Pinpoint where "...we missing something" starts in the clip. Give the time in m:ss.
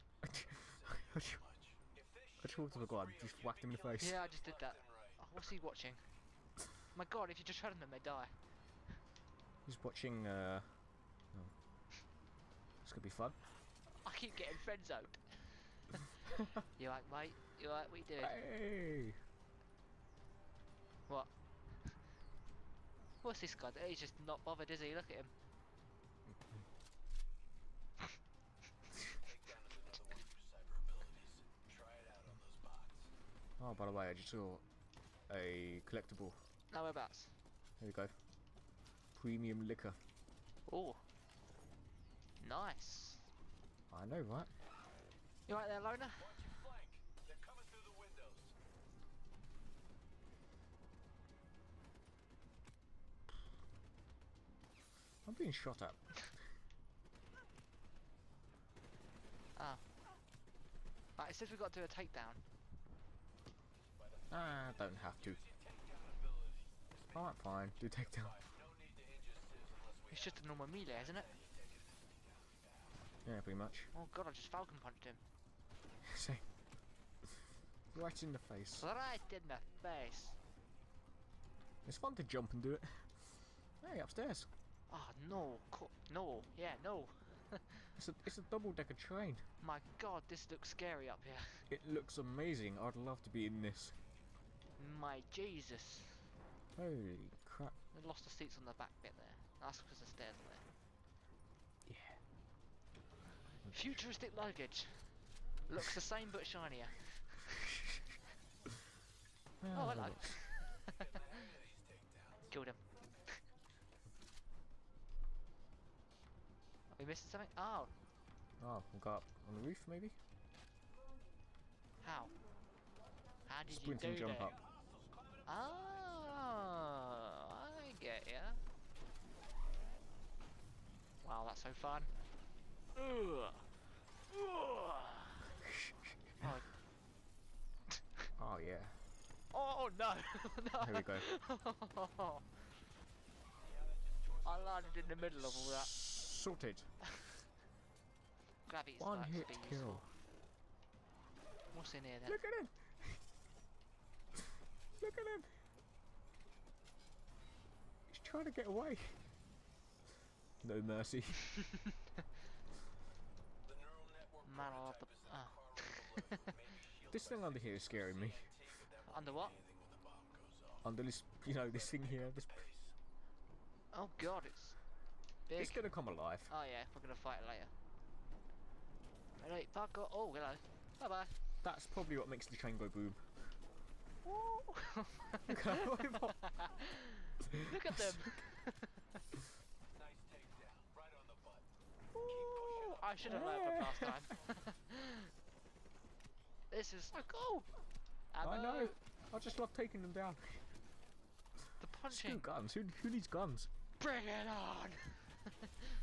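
1:56.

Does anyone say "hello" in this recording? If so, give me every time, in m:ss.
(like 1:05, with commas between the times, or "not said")
1:49, 3:00.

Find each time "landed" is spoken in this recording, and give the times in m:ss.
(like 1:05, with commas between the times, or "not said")
2:24.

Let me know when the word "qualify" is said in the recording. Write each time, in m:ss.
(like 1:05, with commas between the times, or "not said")
not said.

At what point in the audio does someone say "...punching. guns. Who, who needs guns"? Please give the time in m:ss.
3:21.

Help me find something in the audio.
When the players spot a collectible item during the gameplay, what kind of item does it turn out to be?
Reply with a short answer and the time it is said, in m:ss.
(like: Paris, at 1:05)
Premium liquor, at 0:39.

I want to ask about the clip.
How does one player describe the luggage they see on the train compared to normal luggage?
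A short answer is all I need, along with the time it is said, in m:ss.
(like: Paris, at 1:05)
Futuristic luggage, at 1:43.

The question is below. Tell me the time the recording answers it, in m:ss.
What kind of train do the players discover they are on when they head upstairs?
1:28.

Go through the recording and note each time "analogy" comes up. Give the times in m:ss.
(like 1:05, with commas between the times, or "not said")
not said.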